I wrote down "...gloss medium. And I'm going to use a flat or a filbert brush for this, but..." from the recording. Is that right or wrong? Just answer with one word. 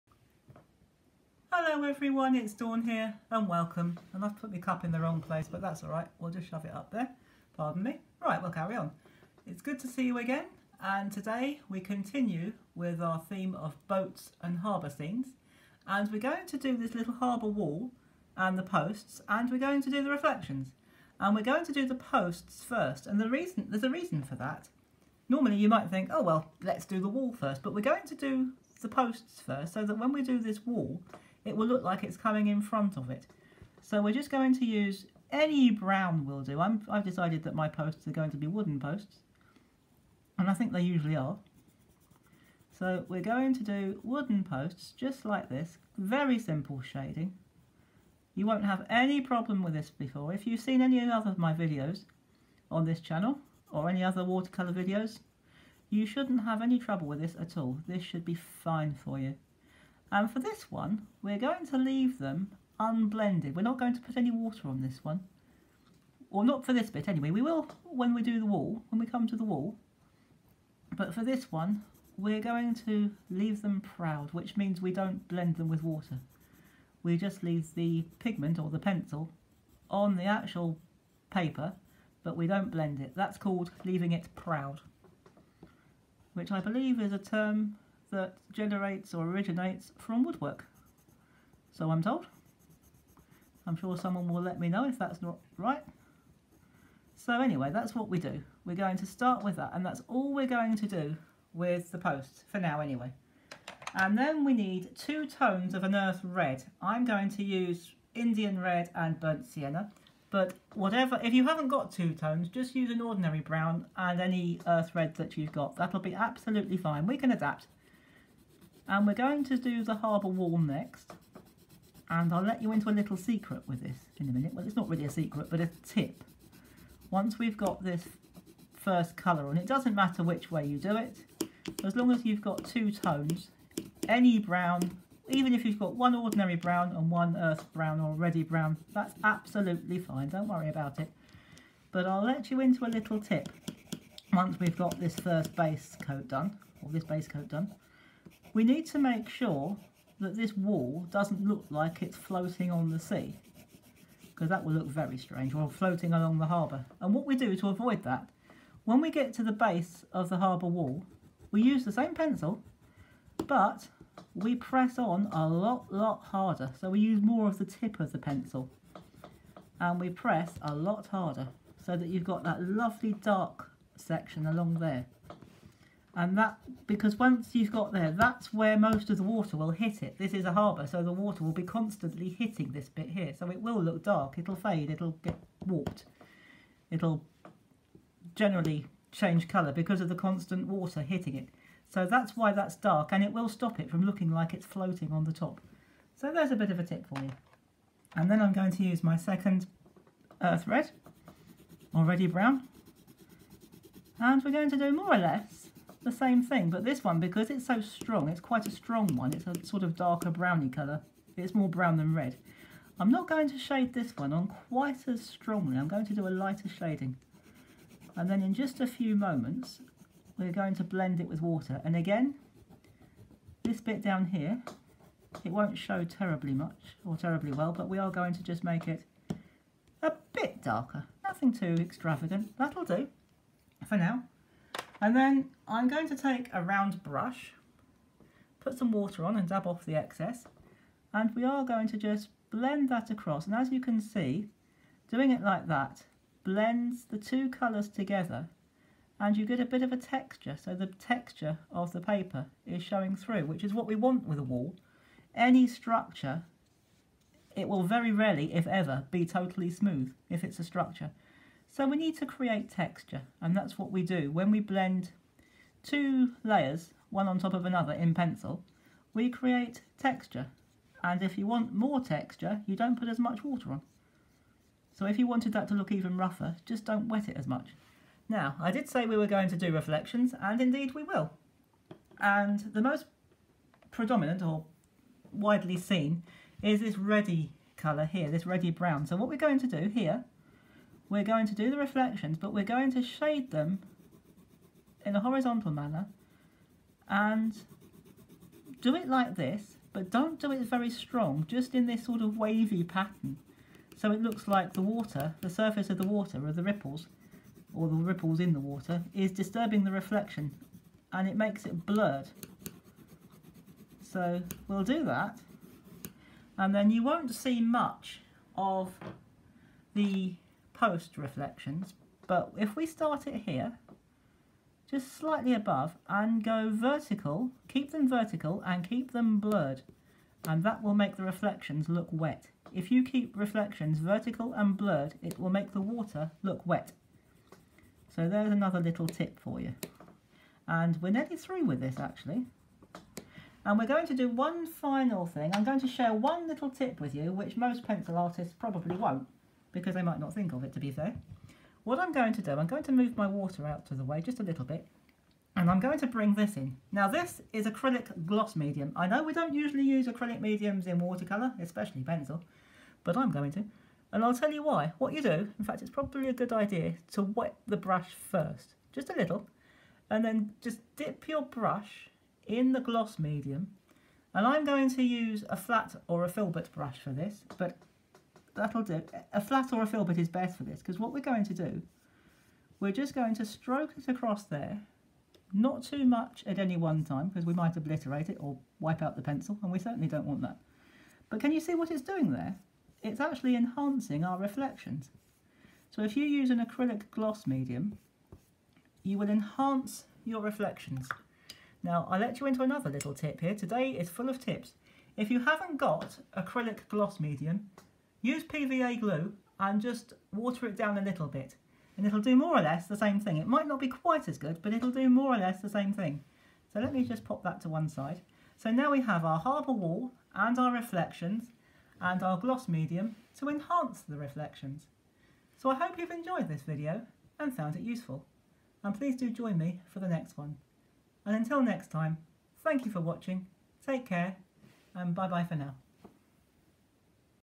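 right.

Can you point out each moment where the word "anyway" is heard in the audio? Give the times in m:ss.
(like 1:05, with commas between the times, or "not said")
1:07, 1:37, 1:42.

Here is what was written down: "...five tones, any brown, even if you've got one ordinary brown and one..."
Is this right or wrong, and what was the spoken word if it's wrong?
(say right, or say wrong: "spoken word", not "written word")
wrong: "two", not "five".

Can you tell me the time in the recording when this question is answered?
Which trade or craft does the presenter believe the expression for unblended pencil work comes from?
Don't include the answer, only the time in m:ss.
1:30.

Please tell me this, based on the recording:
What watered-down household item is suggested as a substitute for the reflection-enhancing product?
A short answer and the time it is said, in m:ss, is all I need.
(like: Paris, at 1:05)
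PVA glue, at 6:48.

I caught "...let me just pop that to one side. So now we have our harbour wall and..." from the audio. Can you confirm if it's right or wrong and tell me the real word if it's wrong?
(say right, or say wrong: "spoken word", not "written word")
right.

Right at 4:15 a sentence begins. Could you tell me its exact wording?
Any structure, it will very rarely, if ever, be totally smooth if it's a structure.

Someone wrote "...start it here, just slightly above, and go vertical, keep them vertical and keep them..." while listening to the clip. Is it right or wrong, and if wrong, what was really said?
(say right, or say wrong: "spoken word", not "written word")
right.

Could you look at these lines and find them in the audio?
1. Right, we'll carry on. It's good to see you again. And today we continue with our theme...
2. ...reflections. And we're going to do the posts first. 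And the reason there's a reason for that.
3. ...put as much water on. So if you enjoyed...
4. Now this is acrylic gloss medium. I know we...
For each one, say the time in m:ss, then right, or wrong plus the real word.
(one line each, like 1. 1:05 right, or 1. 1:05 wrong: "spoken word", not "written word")
1. 0:08 right
2. 0:20 right
3. 4:32 wrong: "wanted", not "enjoyed"
4. 5:56 right.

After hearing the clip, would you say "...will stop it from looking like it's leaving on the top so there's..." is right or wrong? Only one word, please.
wrong.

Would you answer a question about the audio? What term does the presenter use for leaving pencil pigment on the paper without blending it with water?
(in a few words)
leaving it proud.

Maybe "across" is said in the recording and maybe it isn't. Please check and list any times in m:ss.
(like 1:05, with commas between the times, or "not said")
4:03, 6:24.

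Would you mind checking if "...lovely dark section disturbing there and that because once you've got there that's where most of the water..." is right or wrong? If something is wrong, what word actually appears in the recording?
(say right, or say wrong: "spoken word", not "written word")
wrong: "along", not "disturbing".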